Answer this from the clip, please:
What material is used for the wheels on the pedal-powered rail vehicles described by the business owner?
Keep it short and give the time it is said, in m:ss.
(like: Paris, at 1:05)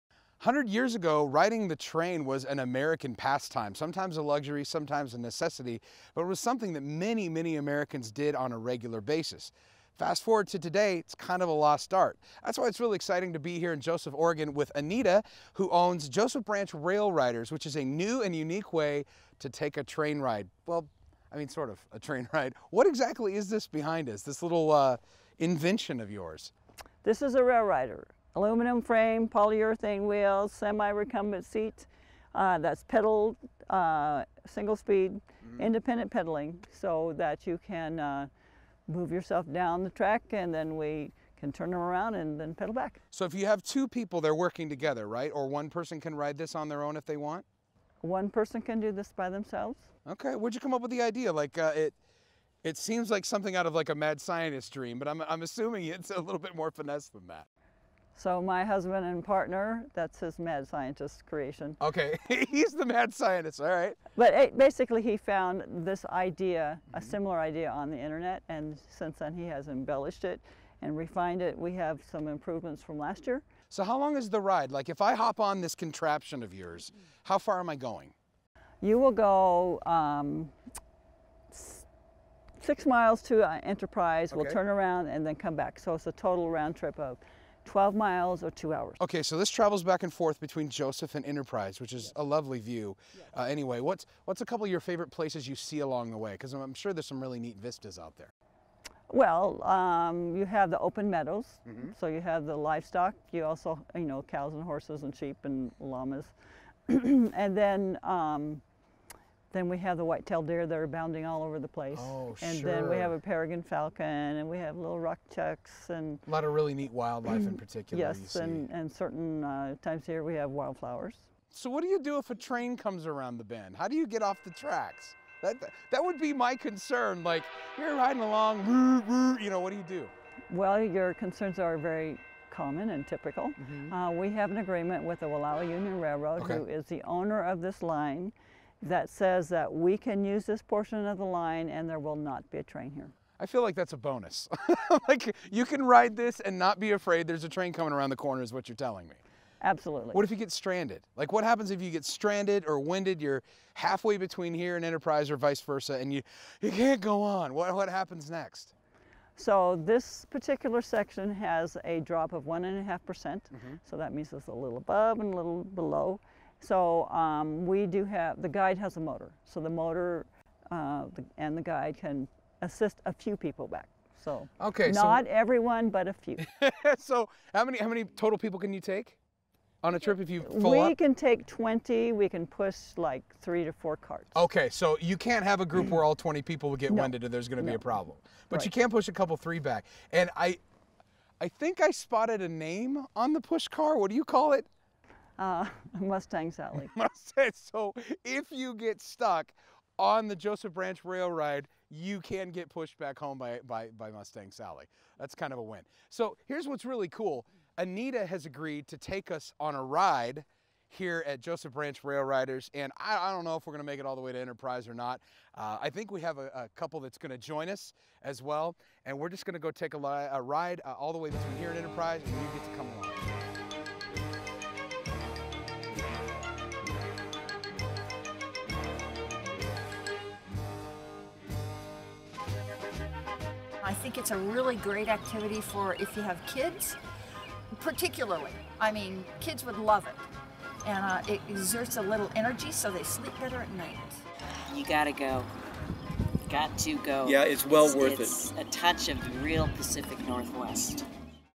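Polyurethane, at 0:29.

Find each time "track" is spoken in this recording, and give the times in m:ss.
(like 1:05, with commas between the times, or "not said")
0:39, 2:04.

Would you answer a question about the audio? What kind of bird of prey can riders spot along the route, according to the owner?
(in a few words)
Peregrine falcon.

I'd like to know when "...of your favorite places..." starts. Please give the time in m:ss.
1:34.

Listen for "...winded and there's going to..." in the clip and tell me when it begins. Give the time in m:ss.
3:07.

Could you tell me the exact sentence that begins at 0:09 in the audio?
Fast forward to today, it's kind of a lost art.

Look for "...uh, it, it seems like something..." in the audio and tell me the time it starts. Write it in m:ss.
0:51.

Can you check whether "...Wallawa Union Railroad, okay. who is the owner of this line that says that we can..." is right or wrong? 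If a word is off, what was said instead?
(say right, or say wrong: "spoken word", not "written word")
right.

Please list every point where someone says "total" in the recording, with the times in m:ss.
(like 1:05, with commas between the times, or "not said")
1:26, 2:58.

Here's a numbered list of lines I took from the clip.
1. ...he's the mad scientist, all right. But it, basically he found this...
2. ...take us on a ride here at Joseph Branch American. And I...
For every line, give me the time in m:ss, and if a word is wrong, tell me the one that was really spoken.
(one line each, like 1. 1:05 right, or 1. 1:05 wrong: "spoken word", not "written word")
1. 1:02 right
2. 3:28 wrong: "Railriders", not "American".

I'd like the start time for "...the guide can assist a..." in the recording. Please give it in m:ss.
2:51.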